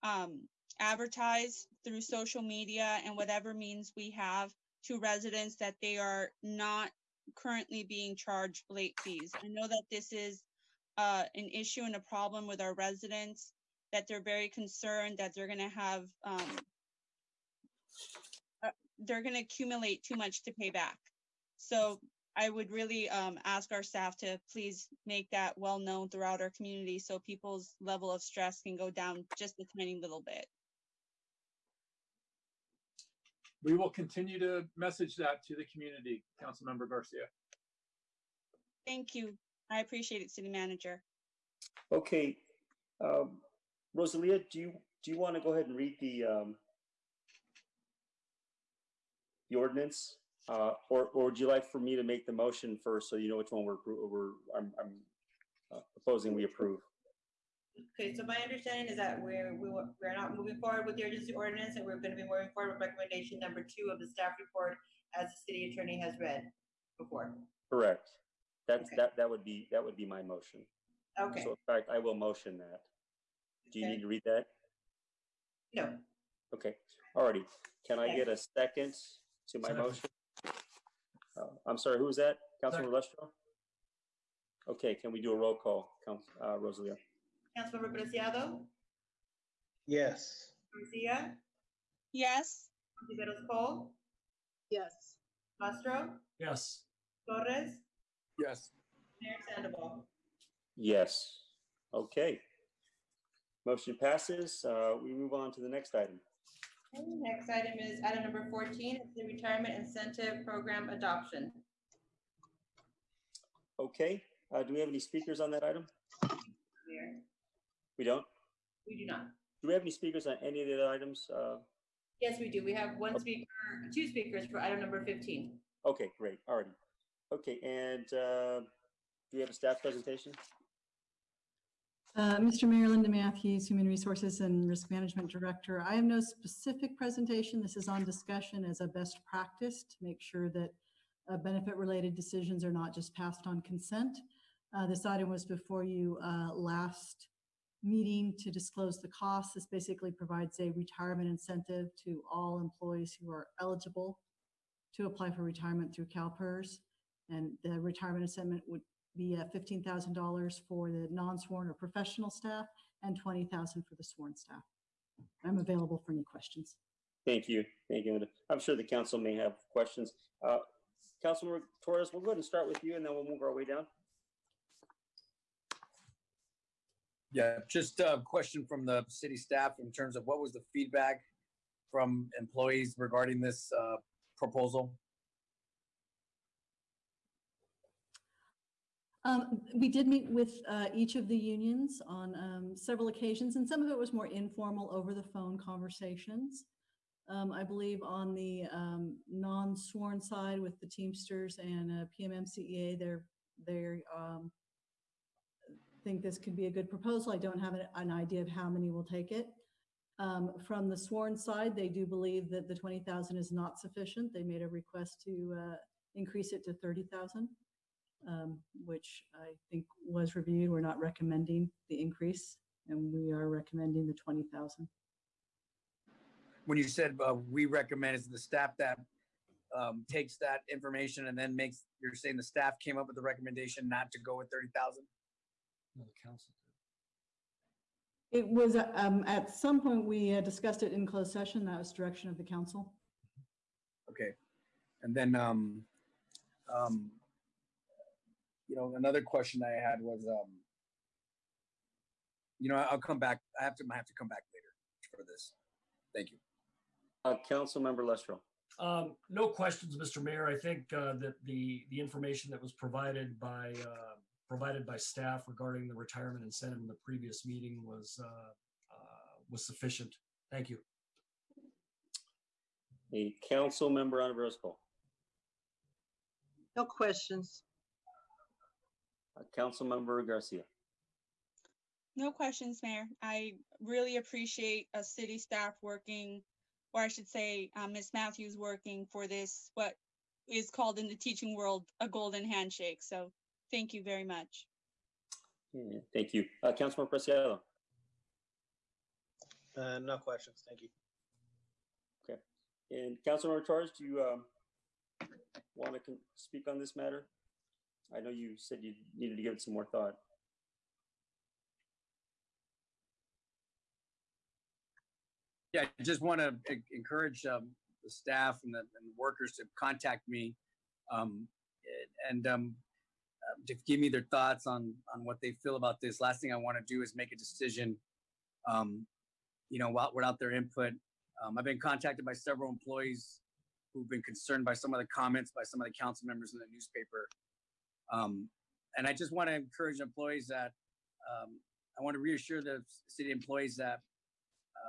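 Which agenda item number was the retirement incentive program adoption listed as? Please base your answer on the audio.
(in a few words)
14.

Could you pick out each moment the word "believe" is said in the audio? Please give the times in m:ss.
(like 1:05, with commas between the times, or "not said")
3:17, 3:32.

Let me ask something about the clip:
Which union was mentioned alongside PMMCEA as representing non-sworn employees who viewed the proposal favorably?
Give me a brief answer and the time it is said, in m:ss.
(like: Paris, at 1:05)
Teamsters, at 3:20.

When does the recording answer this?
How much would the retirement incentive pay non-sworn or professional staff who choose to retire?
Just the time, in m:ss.
2:39.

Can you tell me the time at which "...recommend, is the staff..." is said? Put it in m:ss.
3:47.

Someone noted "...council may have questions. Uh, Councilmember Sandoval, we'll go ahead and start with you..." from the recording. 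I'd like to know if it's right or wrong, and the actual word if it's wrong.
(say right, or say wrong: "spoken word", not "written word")
wrong: "Torres", not "Sandoval".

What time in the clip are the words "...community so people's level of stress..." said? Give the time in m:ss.
0:26.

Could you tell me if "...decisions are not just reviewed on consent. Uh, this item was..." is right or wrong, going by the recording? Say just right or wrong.
wrong.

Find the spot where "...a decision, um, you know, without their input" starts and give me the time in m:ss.
5:27.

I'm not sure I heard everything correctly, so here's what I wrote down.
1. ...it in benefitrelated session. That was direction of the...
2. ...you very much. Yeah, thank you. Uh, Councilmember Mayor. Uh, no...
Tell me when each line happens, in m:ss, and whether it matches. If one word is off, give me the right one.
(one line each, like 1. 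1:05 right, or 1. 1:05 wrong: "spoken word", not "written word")
1. 4:00 wrong: "closed", not "benefitrelated"
2. 4:53 wrong: "Preciado", not "Mayor".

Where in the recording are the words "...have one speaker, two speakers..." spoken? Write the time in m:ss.
2:02.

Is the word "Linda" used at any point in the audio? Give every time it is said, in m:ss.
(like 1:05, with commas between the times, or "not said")
2:12, 2:48.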